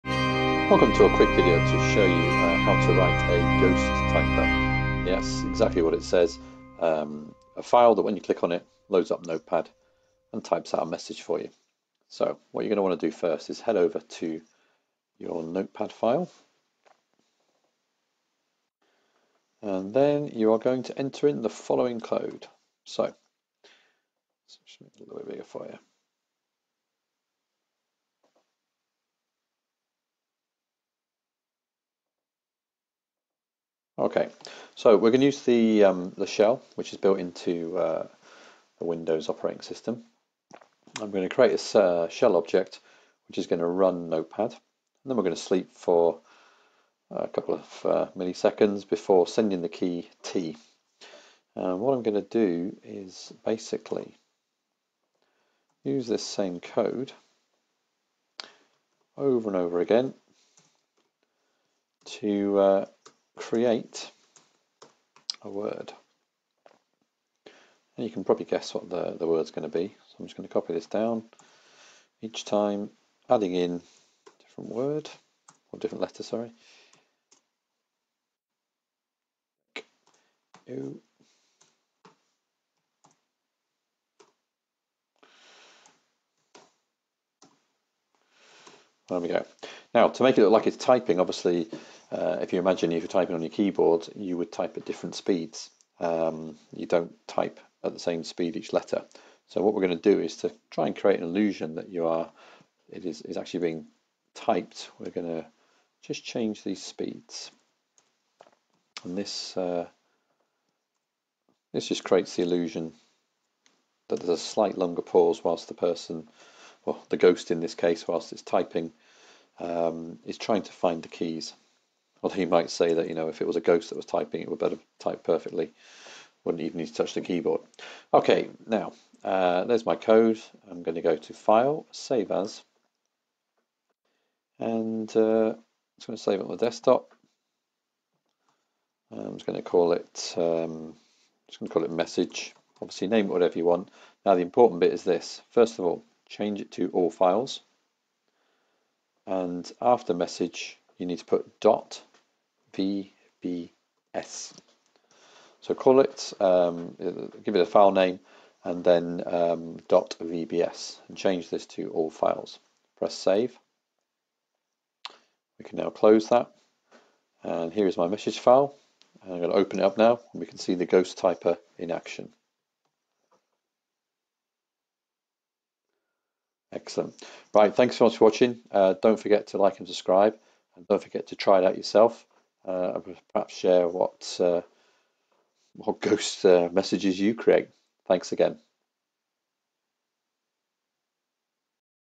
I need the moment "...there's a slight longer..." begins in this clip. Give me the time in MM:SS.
01:54.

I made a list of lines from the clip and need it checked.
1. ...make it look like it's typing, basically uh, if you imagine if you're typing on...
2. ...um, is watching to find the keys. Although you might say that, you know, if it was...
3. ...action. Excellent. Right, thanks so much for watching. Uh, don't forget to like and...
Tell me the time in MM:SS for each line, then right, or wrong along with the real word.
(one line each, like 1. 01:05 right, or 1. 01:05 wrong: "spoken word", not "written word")
1. 01:30 wrong: "obviously", not "basically"
2. 01:59 wrong: "trying", not "watching"
3. 02:51 right.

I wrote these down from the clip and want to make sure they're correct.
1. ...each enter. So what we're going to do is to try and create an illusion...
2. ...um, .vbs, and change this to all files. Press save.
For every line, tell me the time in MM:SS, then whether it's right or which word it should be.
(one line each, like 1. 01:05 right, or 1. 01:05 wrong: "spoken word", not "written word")
1. 01:38 wrong: "letter", not "enter"
2. 02:39 right.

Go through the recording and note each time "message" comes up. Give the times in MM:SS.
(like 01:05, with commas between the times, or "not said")
00:10, 02:21, 02:30, 02:48, 03:06.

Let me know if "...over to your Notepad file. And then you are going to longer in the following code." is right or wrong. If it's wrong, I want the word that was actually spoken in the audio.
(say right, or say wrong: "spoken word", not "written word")
wrong: "enter", not "longer".